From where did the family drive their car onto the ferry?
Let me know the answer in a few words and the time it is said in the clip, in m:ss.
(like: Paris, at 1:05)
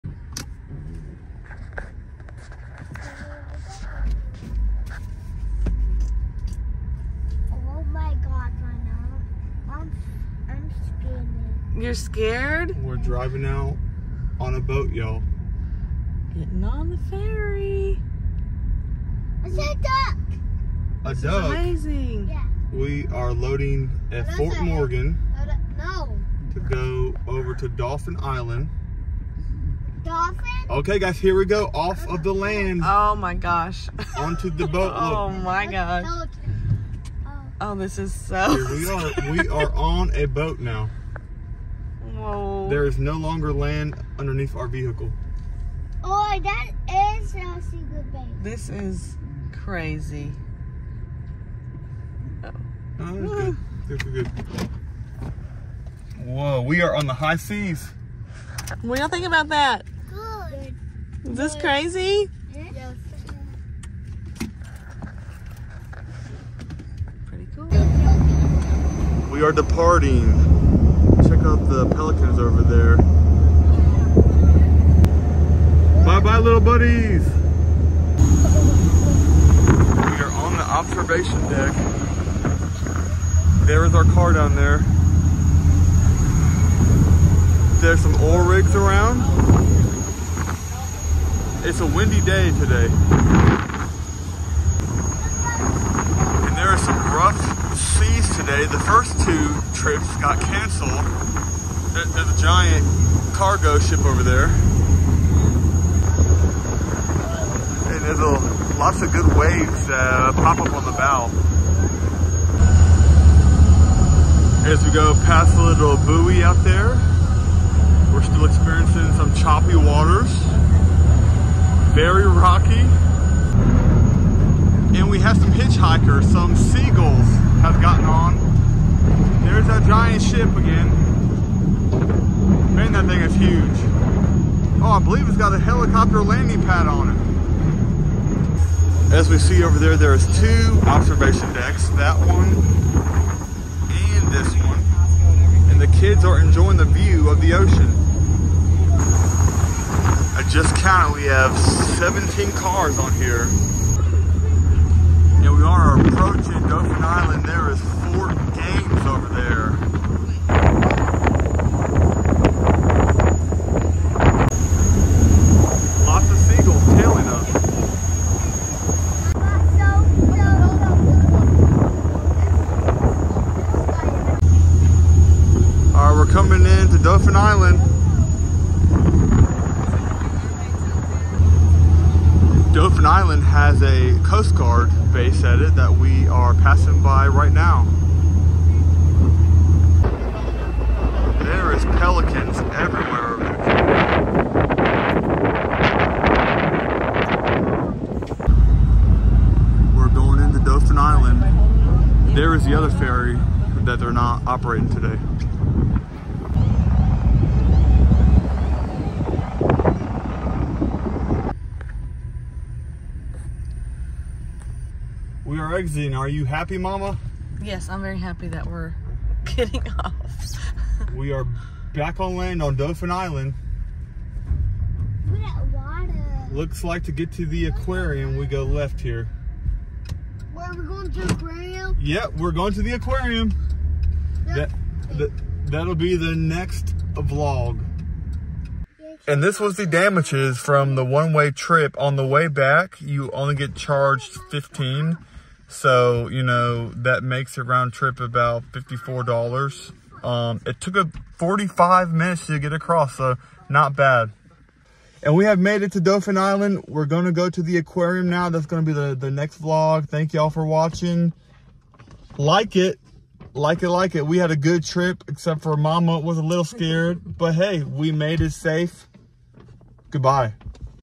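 Fort Morgan, at 0:24.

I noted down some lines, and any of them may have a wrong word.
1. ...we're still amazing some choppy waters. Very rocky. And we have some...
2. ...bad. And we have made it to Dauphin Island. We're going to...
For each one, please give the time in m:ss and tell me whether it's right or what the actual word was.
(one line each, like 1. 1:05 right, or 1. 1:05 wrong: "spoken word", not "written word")
1. 1:58 wrong: "experiencing", not "amazing"
2. 4:13 right.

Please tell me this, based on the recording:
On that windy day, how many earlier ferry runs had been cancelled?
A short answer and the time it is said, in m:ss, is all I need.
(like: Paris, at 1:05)
2, at 1:38.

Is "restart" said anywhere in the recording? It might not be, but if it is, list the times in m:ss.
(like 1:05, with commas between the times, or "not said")
not said.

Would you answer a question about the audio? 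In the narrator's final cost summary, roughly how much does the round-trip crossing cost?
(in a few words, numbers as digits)
$54.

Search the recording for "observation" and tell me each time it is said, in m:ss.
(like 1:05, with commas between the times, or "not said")
1:20, 2:20.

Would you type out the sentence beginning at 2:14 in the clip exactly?
Oh, I believe it's got a helicopter landing pad on it.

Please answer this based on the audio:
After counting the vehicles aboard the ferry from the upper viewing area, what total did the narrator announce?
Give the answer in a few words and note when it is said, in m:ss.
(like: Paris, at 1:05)
17, at 2:31.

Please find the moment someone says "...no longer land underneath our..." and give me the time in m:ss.
0:42.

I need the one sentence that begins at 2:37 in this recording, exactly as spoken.
There is Fort Gaines over there.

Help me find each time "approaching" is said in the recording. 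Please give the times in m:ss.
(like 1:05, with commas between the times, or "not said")
2:36.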